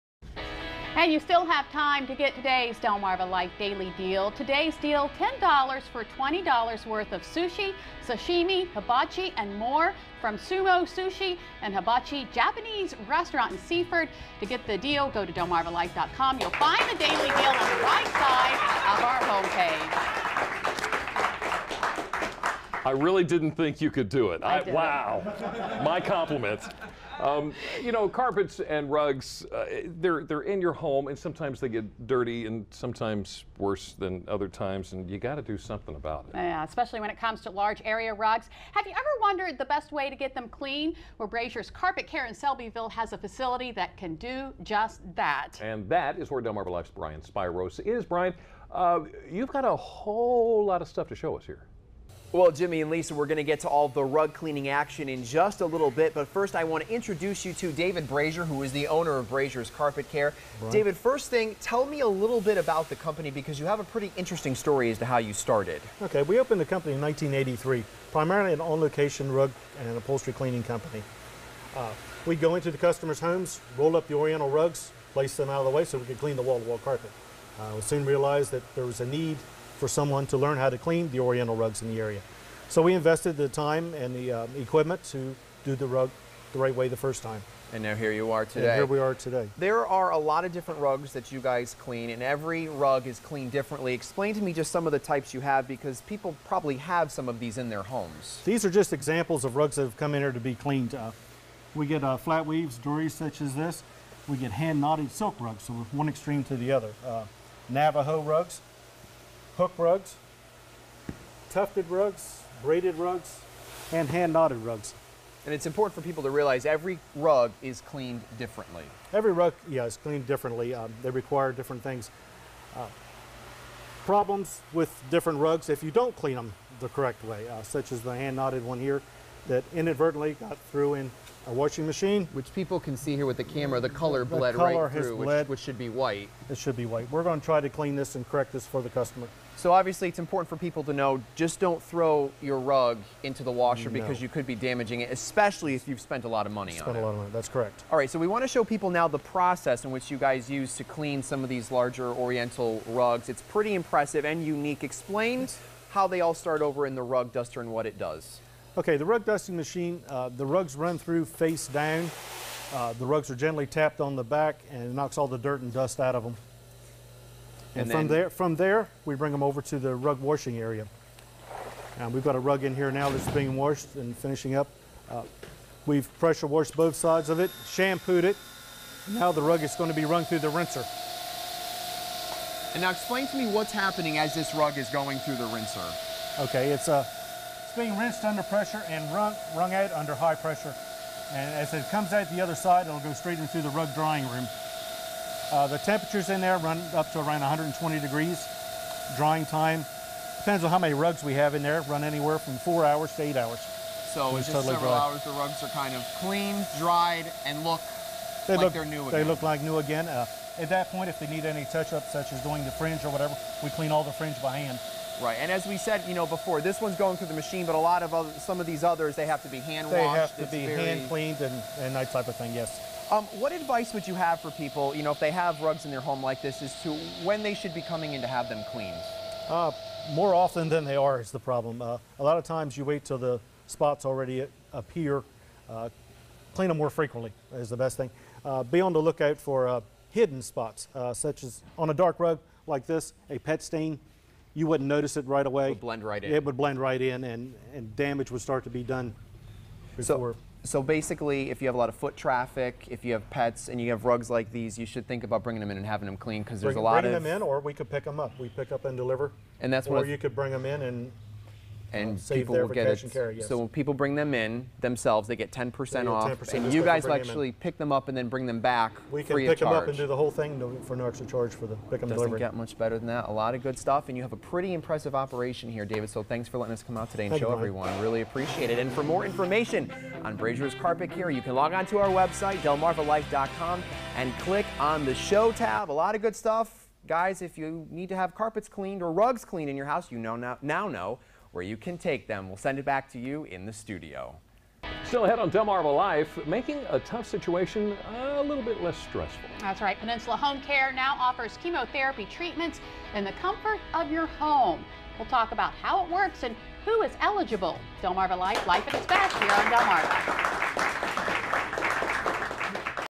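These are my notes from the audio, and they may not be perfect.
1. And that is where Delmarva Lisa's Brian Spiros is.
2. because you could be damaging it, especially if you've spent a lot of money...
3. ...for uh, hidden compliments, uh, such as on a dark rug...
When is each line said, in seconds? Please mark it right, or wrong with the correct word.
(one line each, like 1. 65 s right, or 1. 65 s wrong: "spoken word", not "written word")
1. 45 s wrong: "Life", not "Lisa"
2. 143 s right
3. 239 s wrong: "spots", not "compliments".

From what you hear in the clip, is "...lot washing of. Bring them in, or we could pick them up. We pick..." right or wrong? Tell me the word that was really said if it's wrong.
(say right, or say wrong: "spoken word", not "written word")
wrong: "bringing", not "washing".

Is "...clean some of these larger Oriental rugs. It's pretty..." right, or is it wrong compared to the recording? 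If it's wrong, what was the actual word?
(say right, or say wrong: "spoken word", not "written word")
right.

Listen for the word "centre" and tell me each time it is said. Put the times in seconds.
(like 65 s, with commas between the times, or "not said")
not said.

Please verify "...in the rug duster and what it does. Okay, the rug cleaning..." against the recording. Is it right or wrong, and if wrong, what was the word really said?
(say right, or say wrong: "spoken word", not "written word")
wrong: "dusting", not "cleaning".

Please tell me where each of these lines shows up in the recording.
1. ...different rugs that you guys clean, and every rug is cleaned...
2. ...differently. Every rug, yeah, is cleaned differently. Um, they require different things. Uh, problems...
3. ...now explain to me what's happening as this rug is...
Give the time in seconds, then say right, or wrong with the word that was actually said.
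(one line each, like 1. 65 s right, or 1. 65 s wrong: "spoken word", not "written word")
1. 90 s right
2. 118 s right
3. 182 s right.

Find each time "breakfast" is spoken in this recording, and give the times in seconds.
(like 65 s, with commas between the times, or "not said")
not said.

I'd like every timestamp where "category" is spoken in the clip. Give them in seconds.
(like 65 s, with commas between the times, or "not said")
not said.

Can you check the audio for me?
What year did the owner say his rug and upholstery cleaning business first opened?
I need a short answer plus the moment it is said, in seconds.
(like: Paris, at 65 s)
1983, at 67 s.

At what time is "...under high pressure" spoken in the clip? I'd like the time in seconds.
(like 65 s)
189 s.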